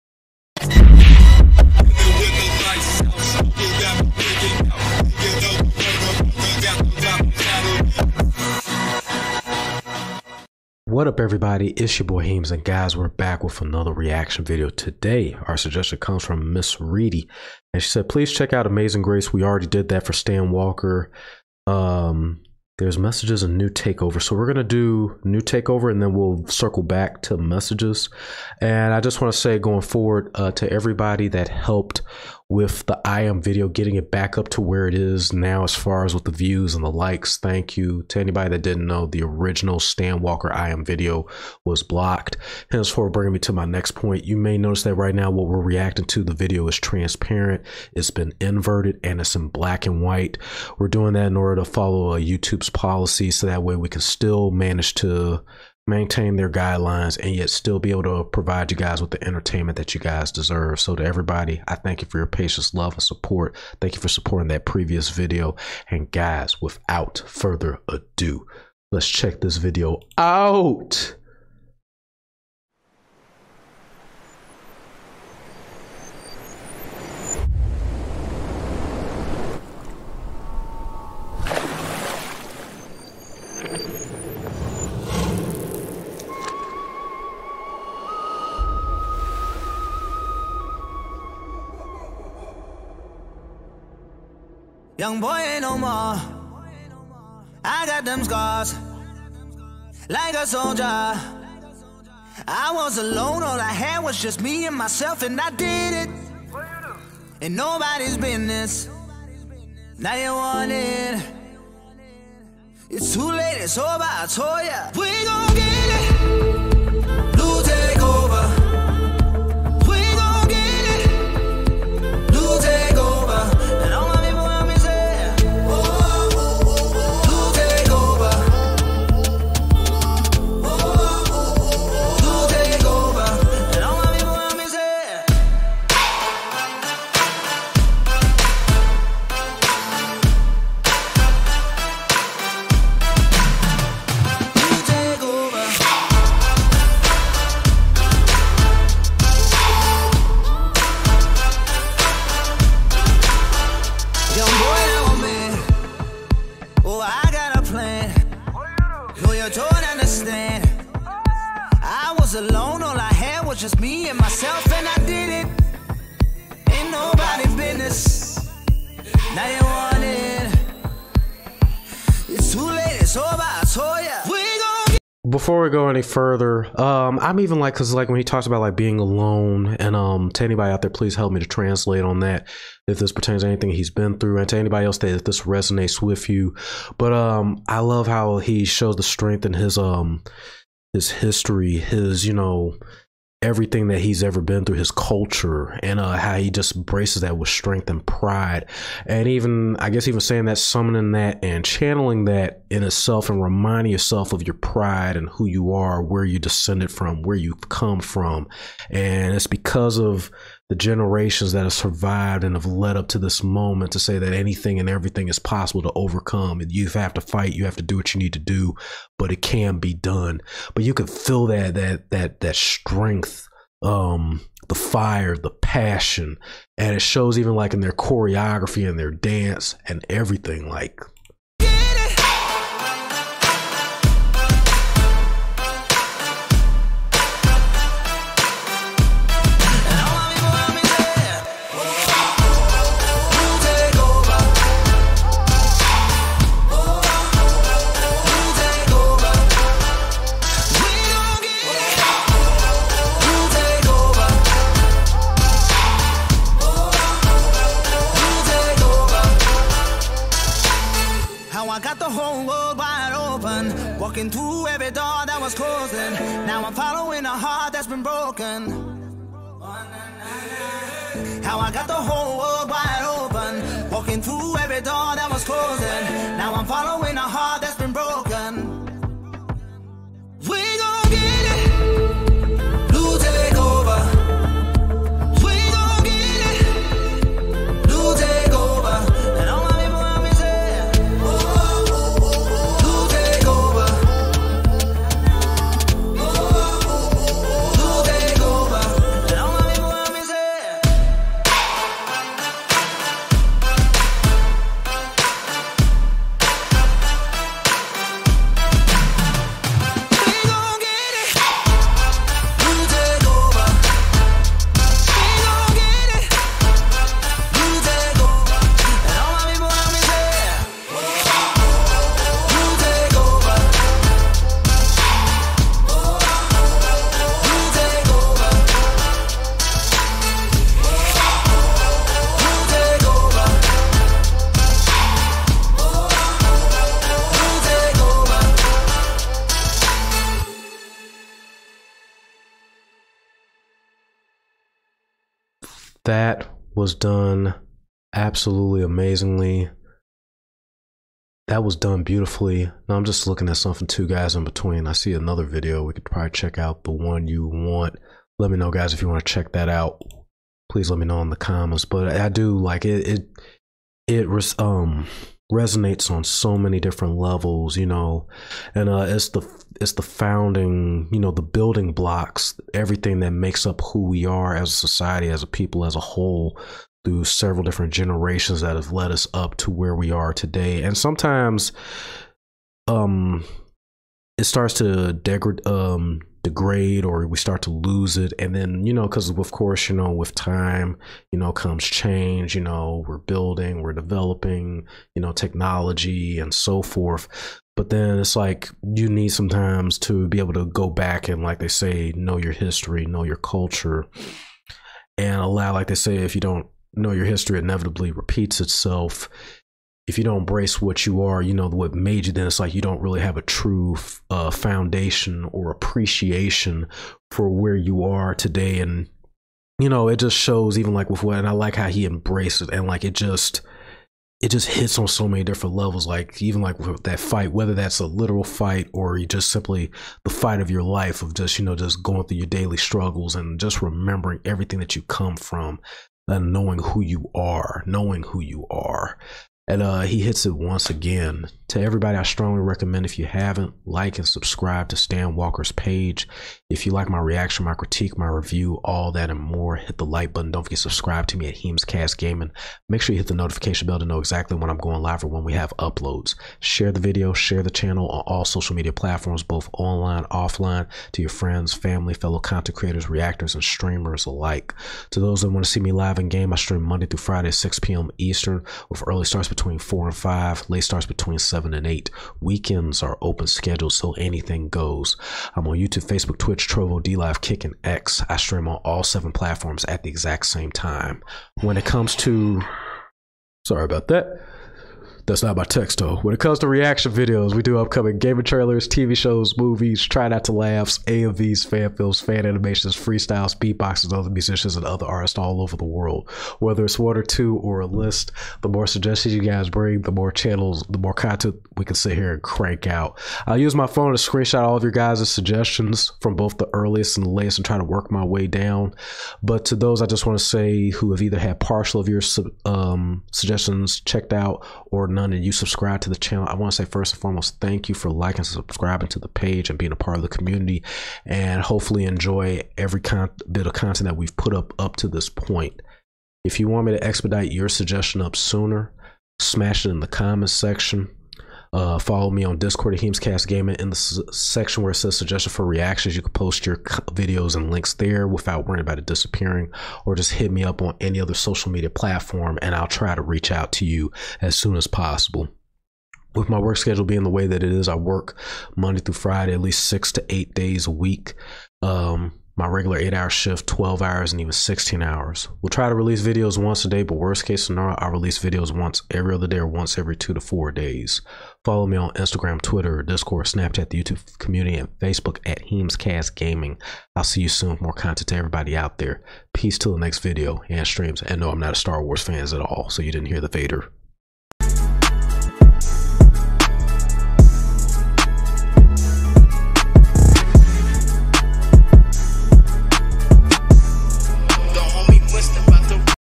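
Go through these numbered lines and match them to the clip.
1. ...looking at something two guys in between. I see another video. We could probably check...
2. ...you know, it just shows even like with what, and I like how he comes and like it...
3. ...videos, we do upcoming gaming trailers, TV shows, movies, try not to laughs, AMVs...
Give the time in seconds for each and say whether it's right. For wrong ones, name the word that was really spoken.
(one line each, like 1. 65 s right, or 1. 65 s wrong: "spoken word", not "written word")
1. 353 s right
2. 419 s wrong: "embraces", not "comes"
3. 487 s right.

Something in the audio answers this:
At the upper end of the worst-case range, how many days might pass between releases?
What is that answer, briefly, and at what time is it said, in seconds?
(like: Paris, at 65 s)
4, at 560 s.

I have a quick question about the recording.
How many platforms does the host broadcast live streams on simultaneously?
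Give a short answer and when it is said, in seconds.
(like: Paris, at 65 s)
7, at 479 s.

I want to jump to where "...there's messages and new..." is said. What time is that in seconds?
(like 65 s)
22 s.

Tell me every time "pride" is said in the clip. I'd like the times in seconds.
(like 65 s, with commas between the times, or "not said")
198 s, 204 s.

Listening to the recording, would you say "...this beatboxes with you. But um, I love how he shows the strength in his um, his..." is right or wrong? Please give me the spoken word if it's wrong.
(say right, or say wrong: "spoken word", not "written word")
wrong: "resonates", not "beatboxes".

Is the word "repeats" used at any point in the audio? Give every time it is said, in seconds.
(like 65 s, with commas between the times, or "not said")
408 s.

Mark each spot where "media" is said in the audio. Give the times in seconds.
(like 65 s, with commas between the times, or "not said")
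458 s, 541 s.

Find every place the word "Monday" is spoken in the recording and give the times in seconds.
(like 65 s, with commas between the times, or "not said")
466 s, 548 s.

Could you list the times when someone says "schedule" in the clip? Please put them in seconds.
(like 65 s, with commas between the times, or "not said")
473 s, 546 s.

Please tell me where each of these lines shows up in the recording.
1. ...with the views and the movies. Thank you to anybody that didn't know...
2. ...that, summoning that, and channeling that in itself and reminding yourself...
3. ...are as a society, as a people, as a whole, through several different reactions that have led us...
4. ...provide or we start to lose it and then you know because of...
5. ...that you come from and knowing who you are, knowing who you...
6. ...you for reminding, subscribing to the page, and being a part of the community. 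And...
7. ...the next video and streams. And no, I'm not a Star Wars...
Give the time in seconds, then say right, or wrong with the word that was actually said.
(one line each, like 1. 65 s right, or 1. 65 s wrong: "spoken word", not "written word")
1. 36 s wrong: "likes", not "movies"
2. 200 s right
3. 374 s wrong: "generations", not "reactions"
4. 386 s wrong: "degrade", not "provide"
5. 434 s right
6. 517 s wrong: "liking", not "reminding"
7. 569 s right.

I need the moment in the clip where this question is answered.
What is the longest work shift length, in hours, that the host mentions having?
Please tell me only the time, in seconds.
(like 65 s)
554 s.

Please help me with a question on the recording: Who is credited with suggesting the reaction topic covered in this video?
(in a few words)
Miss Reedy.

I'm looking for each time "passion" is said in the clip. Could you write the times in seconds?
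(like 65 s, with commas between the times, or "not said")
225 s.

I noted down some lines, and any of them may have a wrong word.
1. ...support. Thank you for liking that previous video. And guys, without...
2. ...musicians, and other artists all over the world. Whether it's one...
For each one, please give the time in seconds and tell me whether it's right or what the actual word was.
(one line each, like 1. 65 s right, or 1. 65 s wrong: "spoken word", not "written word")
1. 63 s wrong: "supporting", not "liking"
2. 494 s right.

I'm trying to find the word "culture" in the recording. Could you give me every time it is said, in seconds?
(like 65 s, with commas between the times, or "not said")
194 s, 403 s.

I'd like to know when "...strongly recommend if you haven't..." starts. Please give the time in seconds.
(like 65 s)
442 s.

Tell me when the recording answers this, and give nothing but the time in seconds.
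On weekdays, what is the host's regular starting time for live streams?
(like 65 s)
467 s.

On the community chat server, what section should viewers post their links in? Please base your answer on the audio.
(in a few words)
suggestion for reactions.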